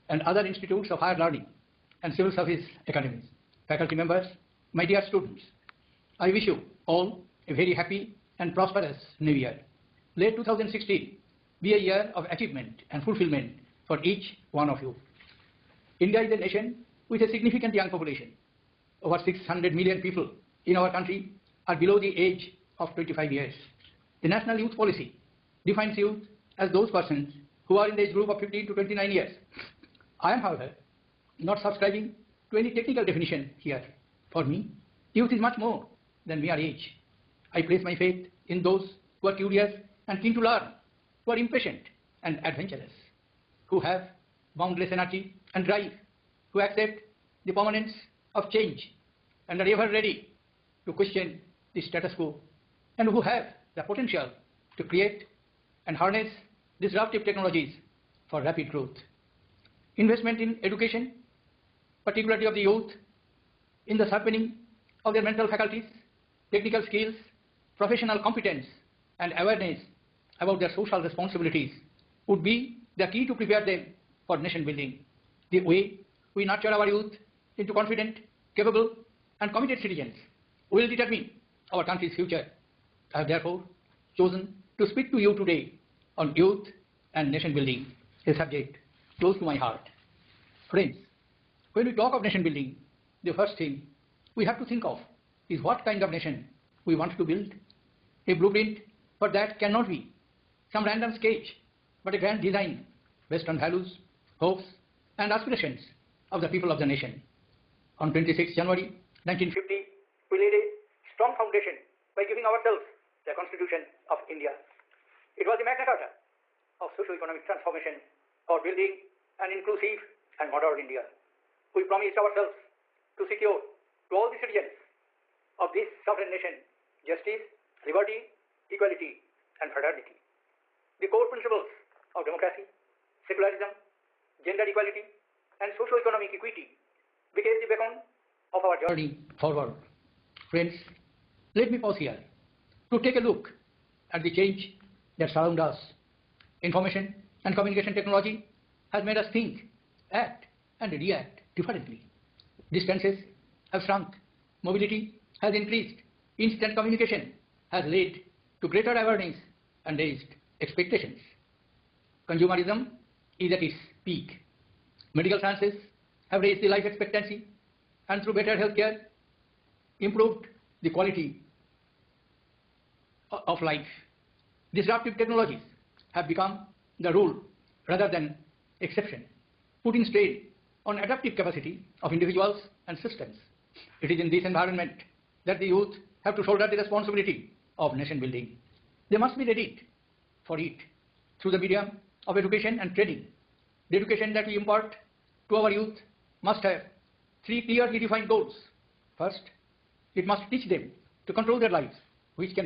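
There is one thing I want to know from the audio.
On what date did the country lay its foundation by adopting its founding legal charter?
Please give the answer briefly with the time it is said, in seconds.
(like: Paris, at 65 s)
26 January 1950, at 108 s.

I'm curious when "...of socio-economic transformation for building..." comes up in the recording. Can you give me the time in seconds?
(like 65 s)
116 s.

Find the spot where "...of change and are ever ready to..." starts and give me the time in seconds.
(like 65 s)
48 s.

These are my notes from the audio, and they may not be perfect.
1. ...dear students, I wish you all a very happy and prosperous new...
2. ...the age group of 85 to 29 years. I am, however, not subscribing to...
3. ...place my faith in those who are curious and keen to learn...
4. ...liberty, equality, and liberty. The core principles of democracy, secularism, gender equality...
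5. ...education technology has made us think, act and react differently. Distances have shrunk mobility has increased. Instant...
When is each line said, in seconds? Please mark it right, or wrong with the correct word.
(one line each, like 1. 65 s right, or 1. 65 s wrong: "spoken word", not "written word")
1. 4 s right
2. 27 s wrong: "15", not "85"
3. 37 s right
4. 127 s wrong: "fraternity", not "liberty"
5. 147 s wrong: "communication", not "education".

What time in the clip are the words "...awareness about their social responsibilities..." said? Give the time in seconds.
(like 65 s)
69 s.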